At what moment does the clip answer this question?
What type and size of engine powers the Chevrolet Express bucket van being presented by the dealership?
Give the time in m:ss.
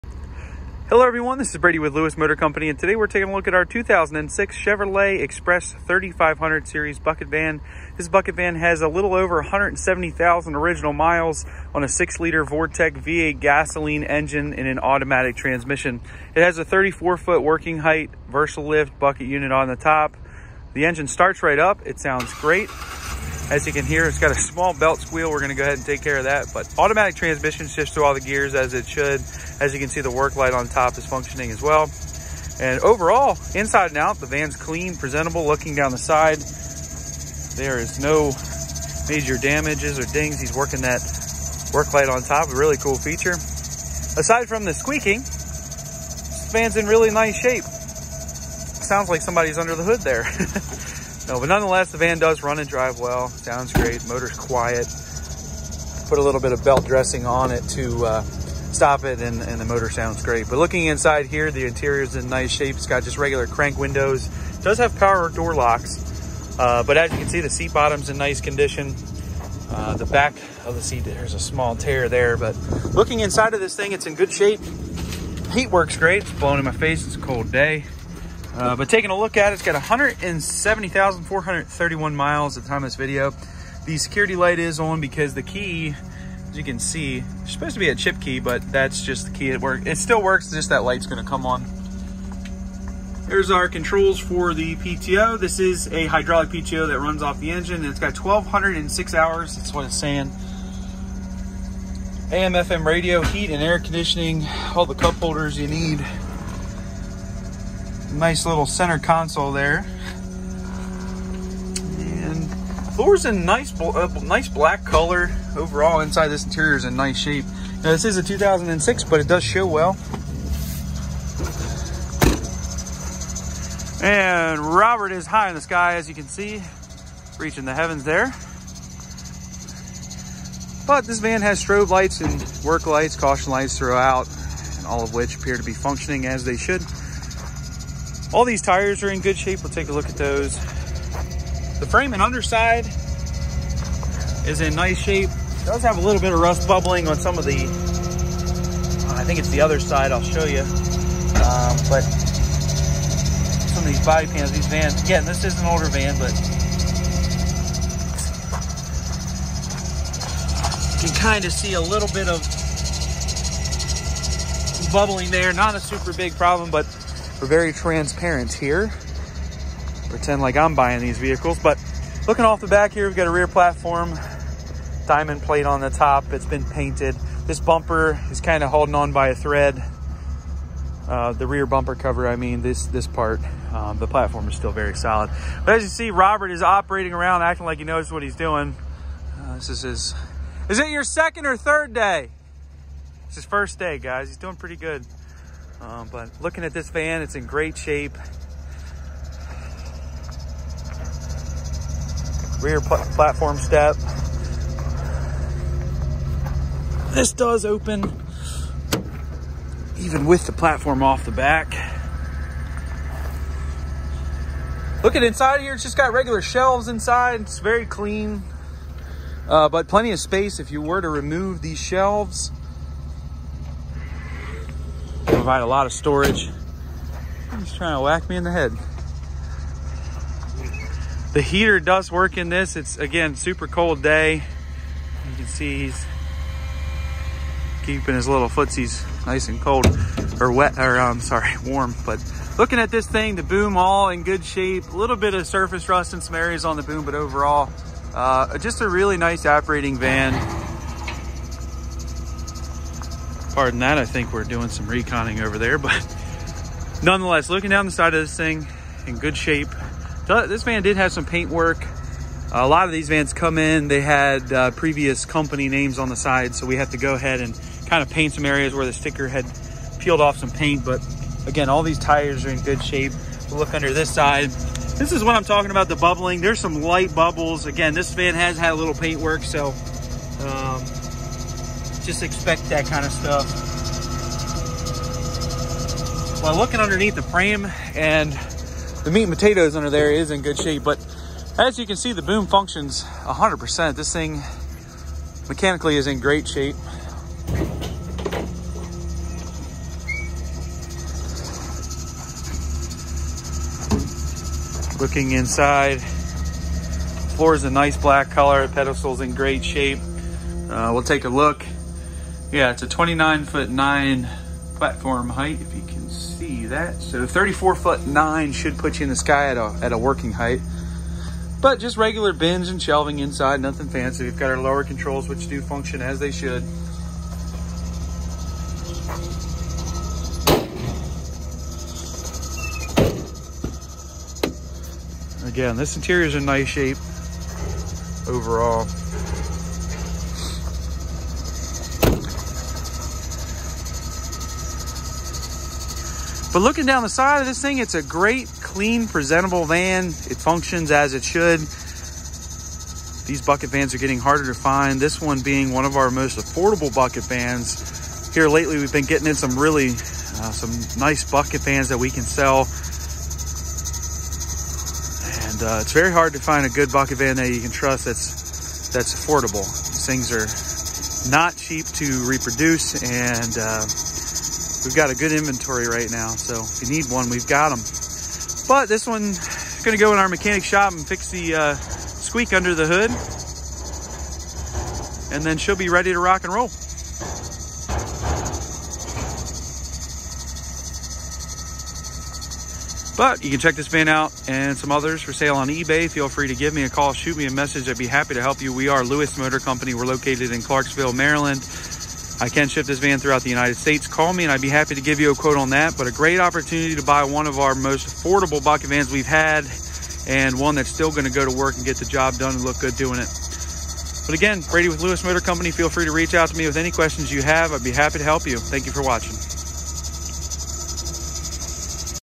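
0:11.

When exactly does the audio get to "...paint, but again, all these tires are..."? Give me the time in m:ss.
4:30.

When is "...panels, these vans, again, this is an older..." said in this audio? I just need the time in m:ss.
2:34.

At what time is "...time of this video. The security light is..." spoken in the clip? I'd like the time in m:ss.
1:22.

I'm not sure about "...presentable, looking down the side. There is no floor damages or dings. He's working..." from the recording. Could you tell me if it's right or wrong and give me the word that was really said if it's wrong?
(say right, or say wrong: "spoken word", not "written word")
wrong: "major", not "floor".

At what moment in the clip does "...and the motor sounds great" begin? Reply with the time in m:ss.
0:59.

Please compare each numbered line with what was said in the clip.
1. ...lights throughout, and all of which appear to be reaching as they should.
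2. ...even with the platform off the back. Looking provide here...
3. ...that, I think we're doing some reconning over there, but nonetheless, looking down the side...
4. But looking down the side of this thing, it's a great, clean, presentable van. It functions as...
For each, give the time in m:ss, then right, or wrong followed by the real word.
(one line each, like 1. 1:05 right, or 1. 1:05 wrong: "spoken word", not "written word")
1. 2:13 wrong: "functioning", not "reaching"
2. 3:29 wrong: "inside", not "provide"
3. 4:13 right
4. 5:46 right.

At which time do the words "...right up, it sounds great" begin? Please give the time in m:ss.
0:21.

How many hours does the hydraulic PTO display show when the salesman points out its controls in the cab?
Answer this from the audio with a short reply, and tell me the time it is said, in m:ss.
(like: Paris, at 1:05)
1,206, at 1:38.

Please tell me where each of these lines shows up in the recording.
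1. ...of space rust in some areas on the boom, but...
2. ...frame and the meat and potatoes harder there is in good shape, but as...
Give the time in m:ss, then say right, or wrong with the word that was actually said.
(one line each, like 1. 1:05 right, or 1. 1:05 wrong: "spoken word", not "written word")
1. 4:05 wrong: "surface", not "space"
2. 4:47 wrong: "under", not "harder".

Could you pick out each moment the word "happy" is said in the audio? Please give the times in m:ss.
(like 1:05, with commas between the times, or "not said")
6:38, 6:44, 6:57.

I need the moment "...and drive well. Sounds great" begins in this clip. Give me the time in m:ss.
0:52.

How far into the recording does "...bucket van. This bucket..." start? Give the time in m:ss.
0:06.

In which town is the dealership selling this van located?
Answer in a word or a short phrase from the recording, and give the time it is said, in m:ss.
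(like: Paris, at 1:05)
Clarksville, Maryland, at 6:40.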